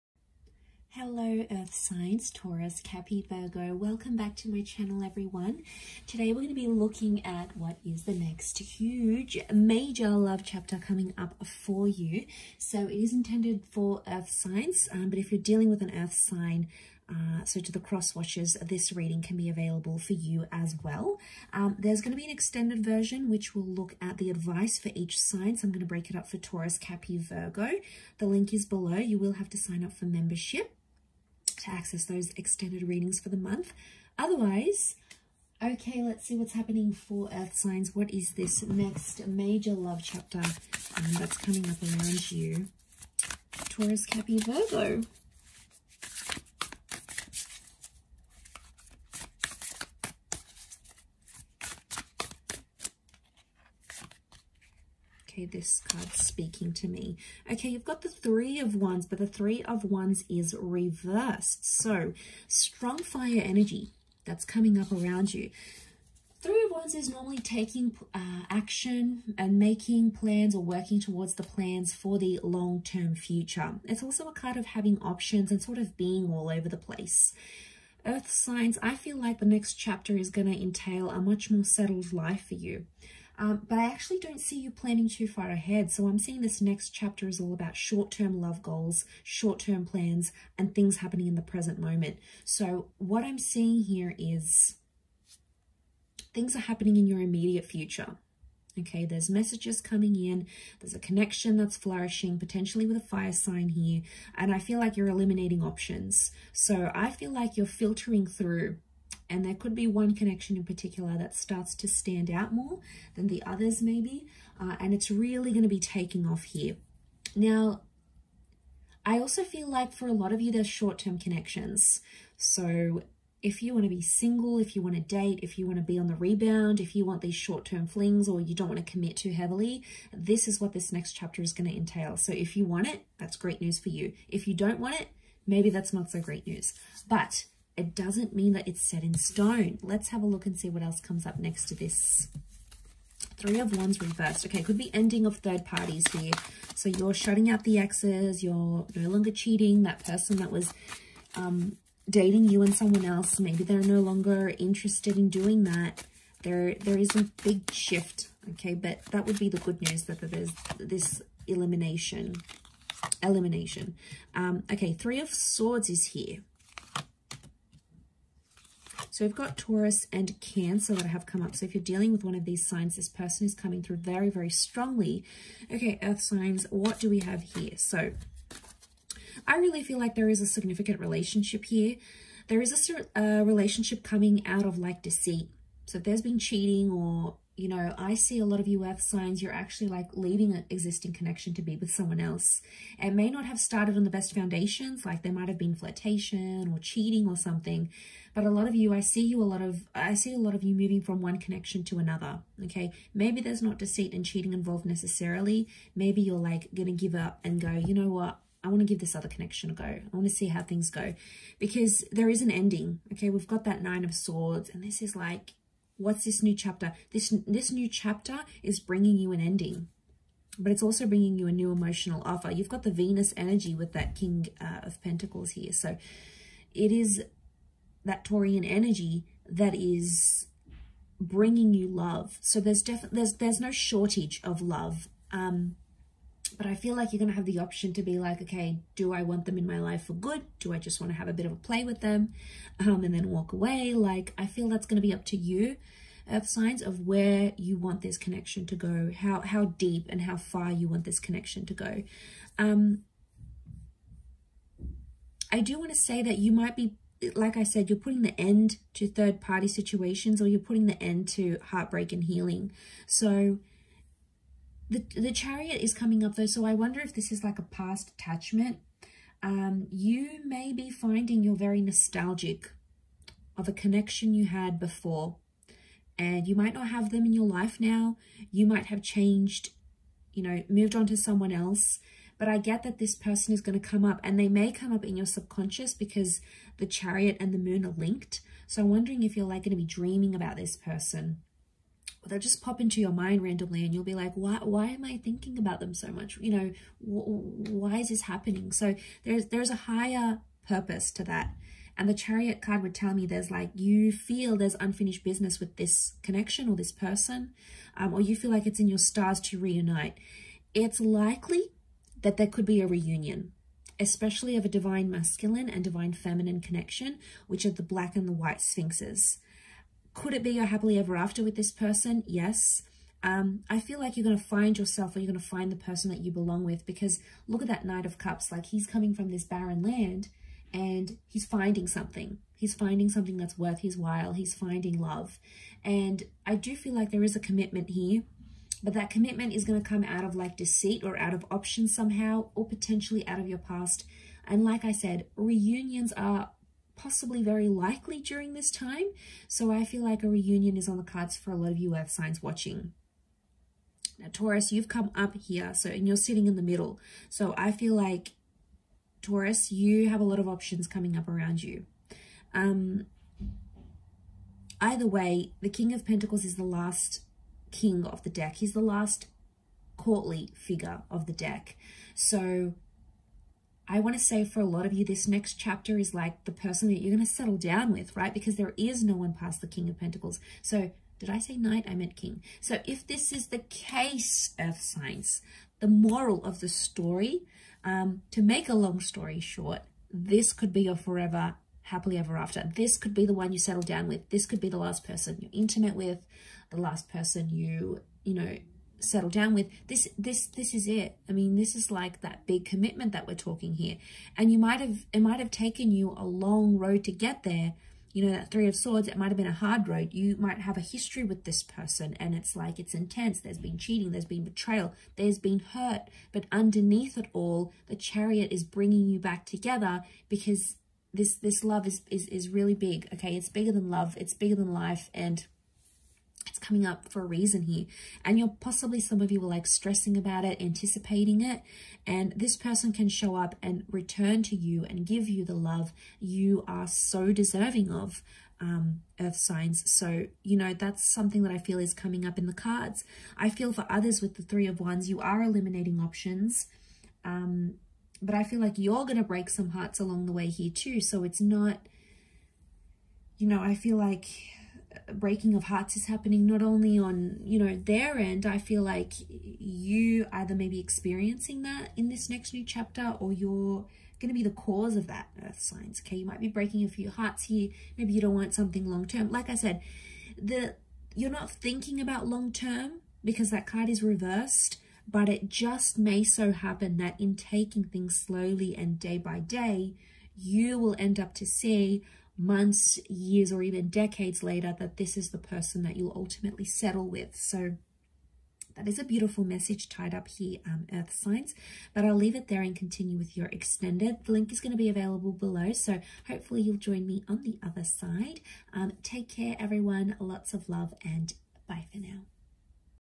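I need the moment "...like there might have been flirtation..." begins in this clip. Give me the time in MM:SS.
03:15.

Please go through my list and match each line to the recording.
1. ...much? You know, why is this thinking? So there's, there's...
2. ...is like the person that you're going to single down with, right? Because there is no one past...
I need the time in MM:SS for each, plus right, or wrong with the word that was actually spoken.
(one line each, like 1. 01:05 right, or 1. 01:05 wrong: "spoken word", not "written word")
1. 04:56 wrong: "happening", not "thinking"
2. 06:15 wrong: "settle", not "single".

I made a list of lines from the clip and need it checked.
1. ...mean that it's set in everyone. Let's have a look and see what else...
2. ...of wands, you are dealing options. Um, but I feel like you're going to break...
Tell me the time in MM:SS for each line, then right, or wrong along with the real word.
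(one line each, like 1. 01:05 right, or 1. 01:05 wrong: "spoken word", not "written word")
1. 02:18 wrong: "stone", not "everyone"
2. 07:24 wrong: "eliminating", not "dealing".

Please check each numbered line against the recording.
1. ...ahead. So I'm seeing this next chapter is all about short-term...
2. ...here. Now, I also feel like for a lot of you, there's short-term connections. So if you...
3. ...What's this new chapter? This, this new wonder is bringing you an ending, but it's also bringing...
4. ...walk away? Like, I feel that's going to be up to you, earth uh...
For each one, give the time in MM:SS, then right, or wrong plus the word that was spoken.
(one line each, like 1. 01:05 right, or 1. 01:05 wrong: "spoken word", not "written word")
1. 01:25 right
2. 01:56 right
3. 03:36 wrong: "chapter", not "wonder"
4. 04:03 right.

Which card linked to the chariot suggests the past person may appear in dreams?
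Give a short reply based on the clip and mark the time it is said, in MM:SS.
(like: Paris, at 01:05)
The Moon, at 04:47.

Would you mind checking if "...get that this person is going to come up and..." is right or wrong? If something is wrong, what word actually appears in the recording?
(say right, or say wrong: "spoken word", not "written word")
right.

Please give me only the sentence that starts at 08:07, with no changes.
So that is a beautiful message tied up here, um, Earth Signs.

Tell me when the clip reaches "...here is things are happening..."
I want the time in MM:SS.
01:33.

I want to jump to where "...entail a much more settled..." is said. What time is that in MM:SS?
01:20.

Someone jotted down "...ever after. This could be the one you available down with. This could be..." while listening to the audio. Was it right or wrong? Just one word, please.
wrong.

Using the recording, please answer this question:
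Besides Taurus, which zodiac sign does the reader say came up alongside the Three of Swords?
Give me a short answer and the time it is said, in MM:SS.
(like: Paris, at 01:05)
Cancer, at 02:50.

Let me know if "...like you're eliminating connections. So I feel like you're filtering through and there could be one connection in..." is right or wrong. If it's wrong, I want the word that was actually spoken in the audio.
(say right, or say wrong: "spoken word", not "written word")
wrong: "options", not "connections".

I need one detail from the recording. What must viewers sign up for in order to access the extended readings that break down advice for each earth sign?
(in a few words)
Membership.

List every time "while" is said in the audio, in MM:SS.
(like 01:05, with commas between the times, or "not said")
05:33.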